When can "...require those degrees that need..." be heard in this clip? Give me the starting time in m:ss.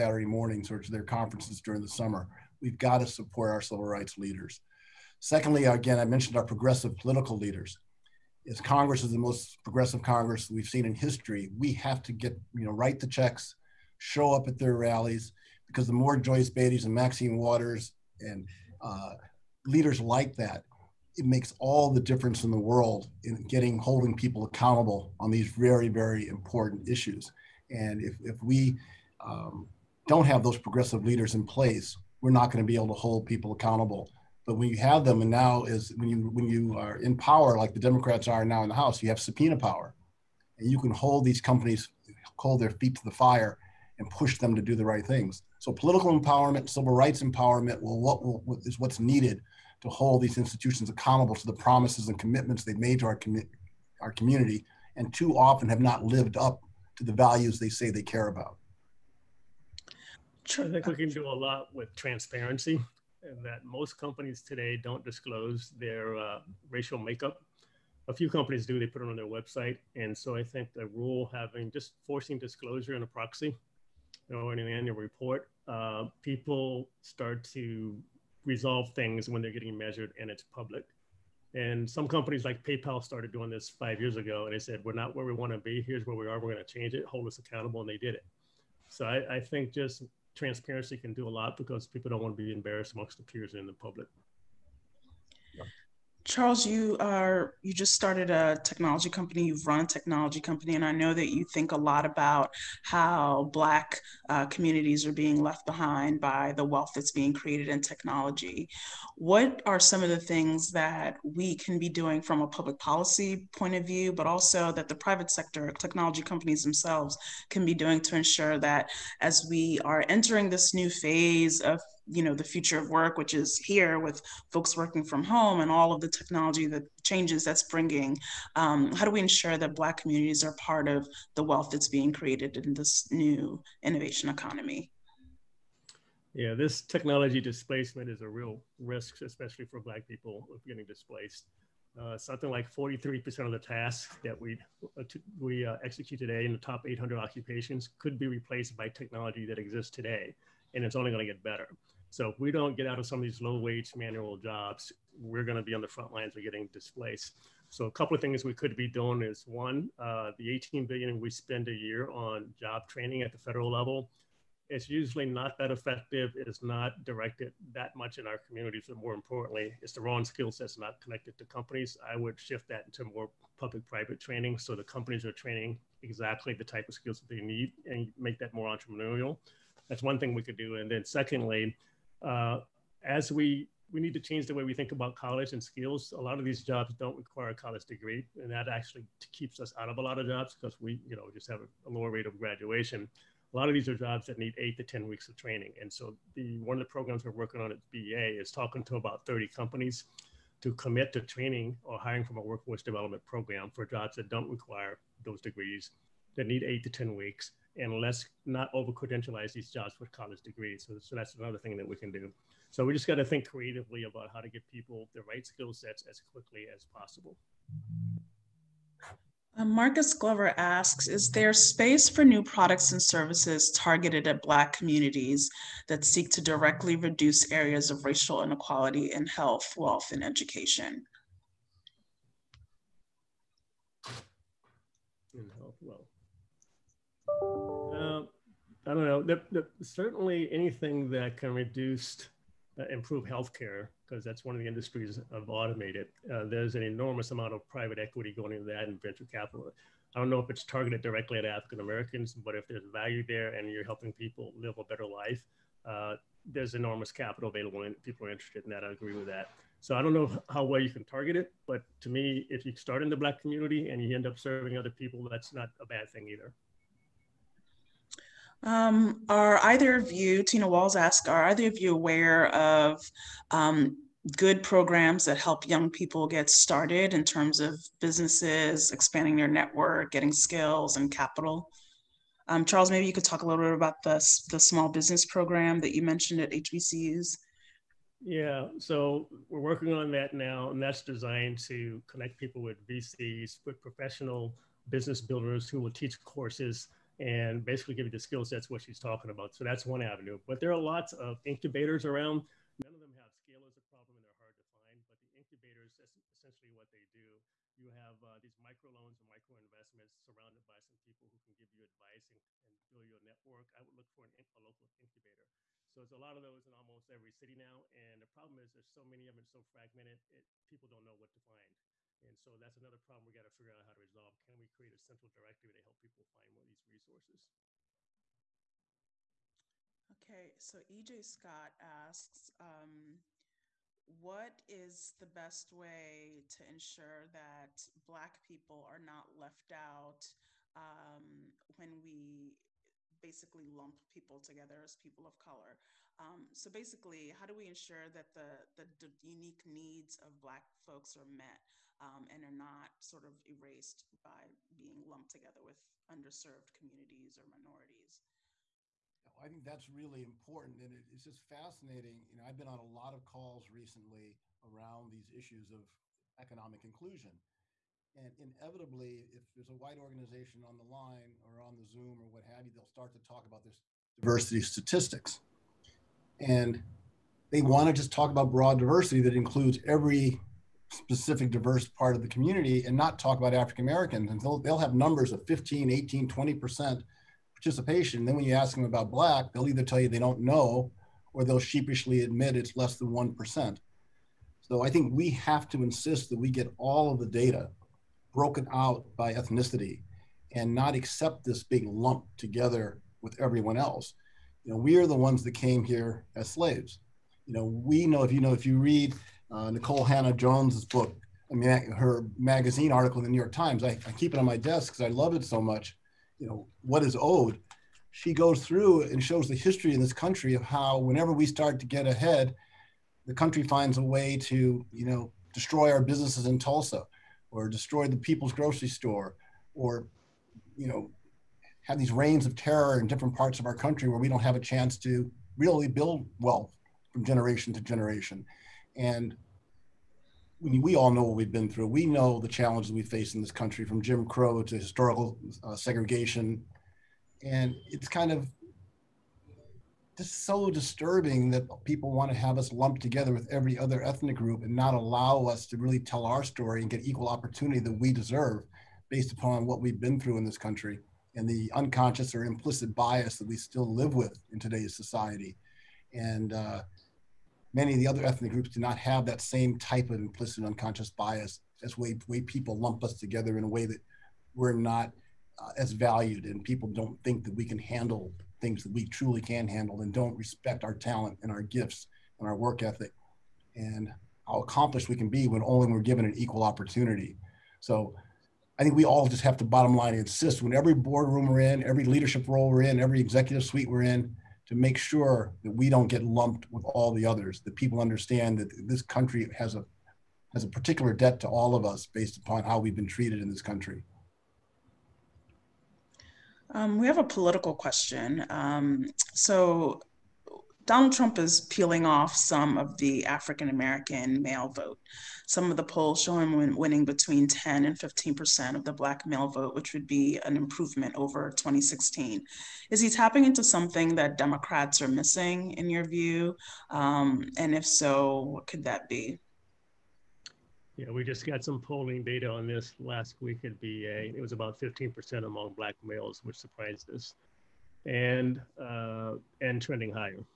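3:24.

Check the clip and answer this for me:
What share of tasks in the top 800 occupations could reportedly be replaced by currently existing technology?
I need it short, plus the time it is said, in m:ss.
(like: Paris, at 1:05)
43%, at 2:22.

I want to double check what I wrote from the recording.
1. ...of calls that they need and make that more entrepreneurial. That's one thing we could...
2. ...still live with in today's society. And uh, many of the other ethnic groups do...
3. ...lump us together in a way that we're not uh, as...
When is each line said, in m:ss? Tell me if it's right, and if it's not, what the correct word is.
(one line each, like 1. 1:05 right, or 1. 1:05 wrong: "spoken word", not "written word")
1. 2:56 wrong: "skills", not "calls"
2. 7:43 right
3. 7:52 right.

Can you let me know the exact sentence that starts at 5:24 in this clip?
Can we create a central directory to help people find more of these resources?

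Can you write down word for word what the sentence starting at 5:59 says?
I think that's really important, and it's just fascinating.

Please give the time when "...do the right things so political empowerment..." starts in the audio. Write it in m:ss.
0:44.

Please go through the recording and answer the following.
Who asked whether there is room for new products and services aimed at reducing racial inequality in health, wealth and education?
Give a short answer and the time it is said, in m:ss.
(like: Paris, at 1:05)
Marcus Glover, at 3:39.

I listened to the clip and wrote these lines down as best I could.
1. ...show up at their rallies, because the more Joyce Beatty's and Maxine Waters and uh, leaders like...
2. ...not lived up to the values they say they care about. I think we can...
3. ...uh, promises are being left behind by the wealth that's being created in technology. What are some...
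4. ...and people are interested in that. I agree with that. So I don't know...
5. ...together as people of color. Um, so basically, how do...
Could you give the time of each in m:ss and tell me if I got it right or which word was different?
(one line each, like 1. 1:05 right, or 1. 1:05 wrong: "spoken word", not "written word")
1. 0:13 right
2. 0:55 right
3. 1:44 wrong: "communities", not "promises"
4. 4:17 right
5. 5:44 right.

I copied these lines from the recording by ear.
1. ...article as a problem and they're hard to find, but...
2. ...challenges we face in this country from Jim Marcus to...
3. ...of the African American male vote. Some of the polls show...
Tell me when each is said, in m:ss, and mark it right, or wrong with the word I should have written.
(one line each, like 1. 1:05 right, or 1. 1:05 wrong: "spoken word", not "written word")
1. 5:03 wrong: "scale", not "article"
2. 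7:22 wrong: "Crow", not "Marcus"
3. 8:32 right.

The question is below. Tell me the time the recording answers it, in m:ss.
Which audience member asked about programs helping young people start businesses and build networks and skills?
4:30.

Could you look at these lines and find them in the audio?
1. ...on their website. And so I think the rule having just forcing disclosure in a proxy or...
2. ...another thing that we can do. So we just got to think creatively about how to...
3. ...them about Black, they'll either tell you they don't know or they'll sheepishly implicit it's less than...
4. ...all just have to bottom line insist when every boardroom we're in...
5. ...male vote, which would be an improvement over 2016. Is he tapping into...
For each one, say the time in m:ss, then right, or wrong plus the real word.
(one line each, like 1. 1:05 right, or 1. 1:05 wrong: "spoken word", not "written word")
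1. 1:09 right
2. 3:31 right
3. 6:28 wrong: "admit", not "implicit"
4. 8:09 right
5. 8:39 right.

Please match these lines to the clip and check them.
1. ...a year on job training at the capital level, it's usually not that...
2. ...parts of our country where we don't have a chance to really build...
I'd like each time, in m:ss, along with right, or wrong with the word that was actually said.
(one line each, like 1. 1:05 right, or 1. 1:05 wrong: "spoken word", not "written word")
1. 2:41 wrong: "federal", not "capital"
2. 7:13 right.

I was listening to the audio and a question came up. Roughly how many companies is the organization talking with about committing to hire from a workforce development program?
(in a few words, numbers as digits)
30.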